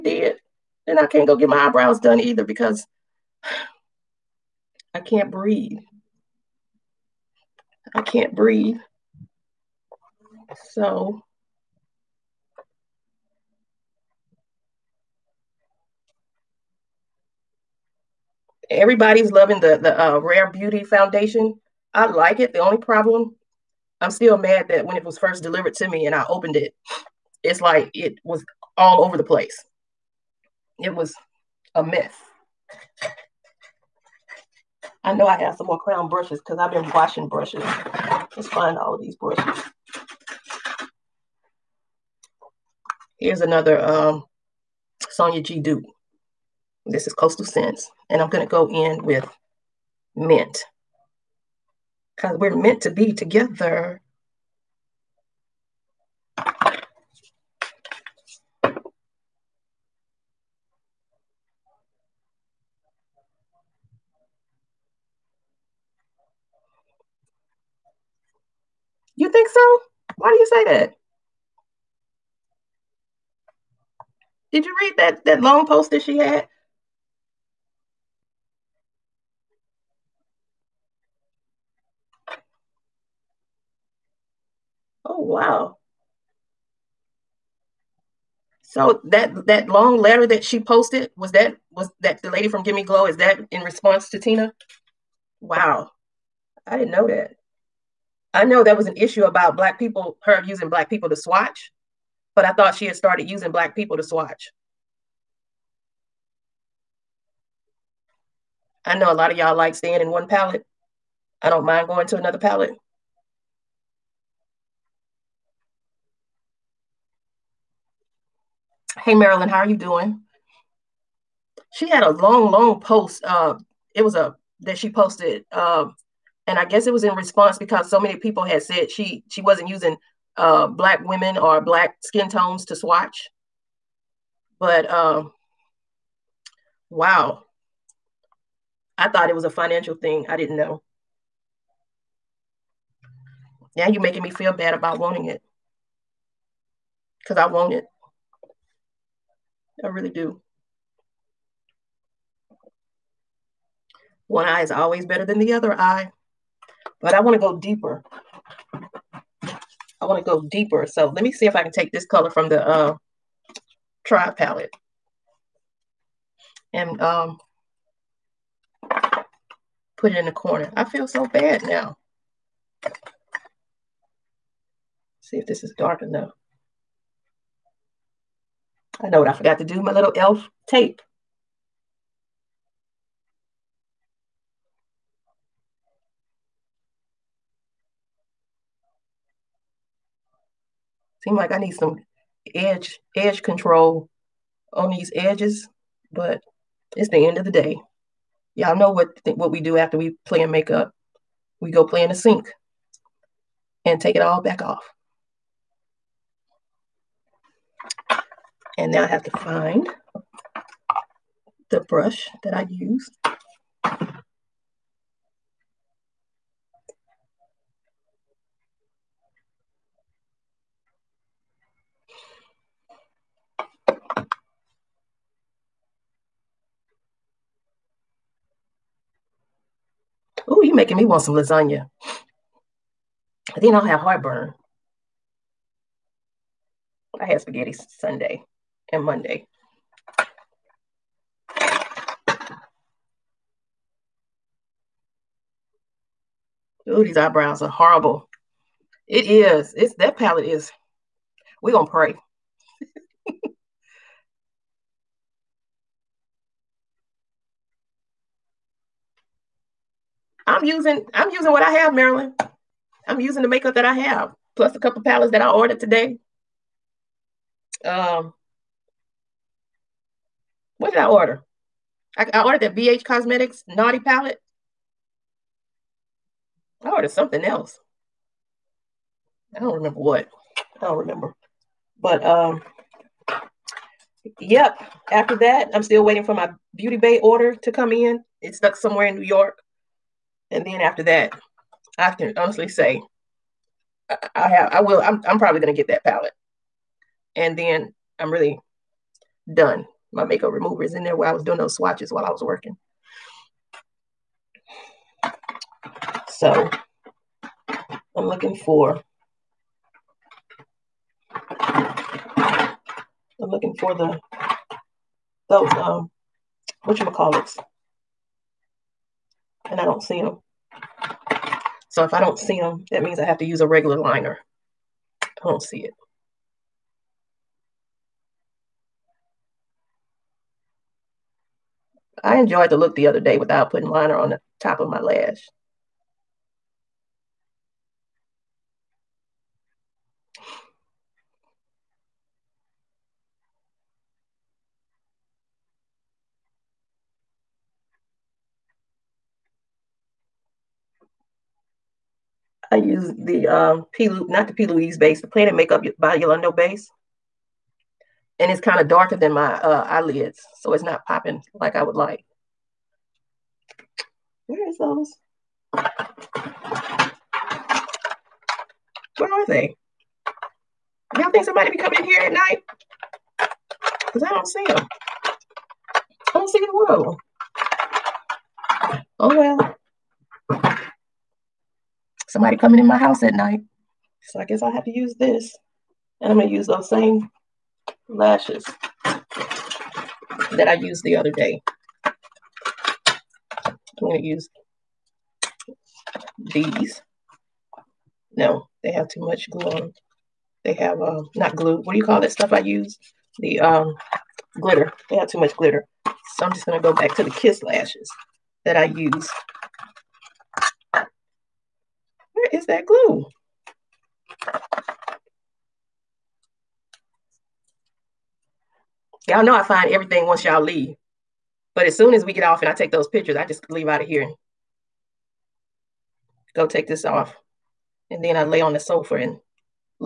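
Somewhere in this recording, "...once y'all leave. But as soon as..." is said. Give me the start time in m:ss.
7:00.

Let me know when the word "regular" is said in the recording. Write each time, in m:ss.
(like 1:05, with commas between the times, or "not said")
5:23.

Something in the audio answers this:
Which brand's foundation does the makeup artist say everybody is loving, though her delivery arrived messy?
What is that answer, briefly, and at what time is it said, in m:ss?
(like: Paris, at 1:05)
Rare Beauty, at 0:20.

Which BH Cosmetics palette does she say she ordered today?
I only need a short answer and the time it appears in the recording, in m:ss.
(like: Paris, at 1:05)
Naughty, at 4:33.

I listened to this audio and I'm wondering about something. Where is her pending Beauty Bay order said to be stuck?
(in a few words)
New York.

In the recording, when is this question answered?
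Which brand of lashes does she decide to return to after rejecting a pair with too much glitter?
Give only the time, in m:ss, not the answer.
6:47.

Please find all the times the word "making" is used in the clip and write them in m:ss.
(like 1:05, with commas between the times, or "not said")
2:24, 3:50.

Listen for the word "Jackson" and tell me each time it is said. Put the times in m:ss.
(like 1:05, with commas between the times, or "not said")
not said.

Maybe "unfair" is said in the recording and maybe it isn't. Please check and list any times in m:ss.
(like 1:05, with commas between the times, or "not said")
not said.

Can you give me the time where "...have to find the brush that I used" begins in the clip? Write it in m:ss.
3:29.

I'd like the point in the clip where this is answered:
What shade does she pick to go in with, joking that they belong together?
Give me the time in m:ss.
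0:50.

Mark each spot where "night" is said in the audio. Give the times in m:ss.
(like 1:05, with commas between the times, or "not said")
6:12, 6:23.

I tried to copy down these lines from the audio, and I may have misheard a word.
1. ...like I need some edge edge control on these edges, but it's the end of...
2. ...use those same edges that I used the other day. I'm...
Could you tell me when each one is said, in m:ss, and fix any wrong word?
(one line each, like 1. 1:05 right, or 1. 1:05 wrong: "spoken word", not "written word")
1. 3:11 right
2. 6:26 wrong: "lashes", not "edges".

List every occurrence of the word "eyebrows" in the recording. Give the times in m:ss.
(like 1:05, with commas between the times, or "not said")
0:01, 4:07.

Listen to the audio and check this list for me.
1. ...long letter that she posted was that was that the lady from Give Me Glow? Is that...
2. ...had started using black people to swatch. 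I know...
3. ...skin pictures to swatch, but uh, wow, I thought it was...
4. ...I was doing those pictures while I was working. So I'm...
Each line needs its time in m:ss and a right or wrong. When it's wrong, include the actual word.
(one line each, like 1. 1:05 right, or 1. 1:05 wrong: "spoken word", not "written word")
1. 1:29 right
2. 1:42 right
3. 2:12 wrong: "tones", not "pictures"
4. 5:01 wrong: "swatches", not "pictures".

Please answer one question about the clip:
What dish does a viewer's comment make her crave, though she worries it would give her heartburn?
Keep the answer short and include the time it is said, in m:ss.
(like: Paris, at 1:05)
lasagna, at 3:51.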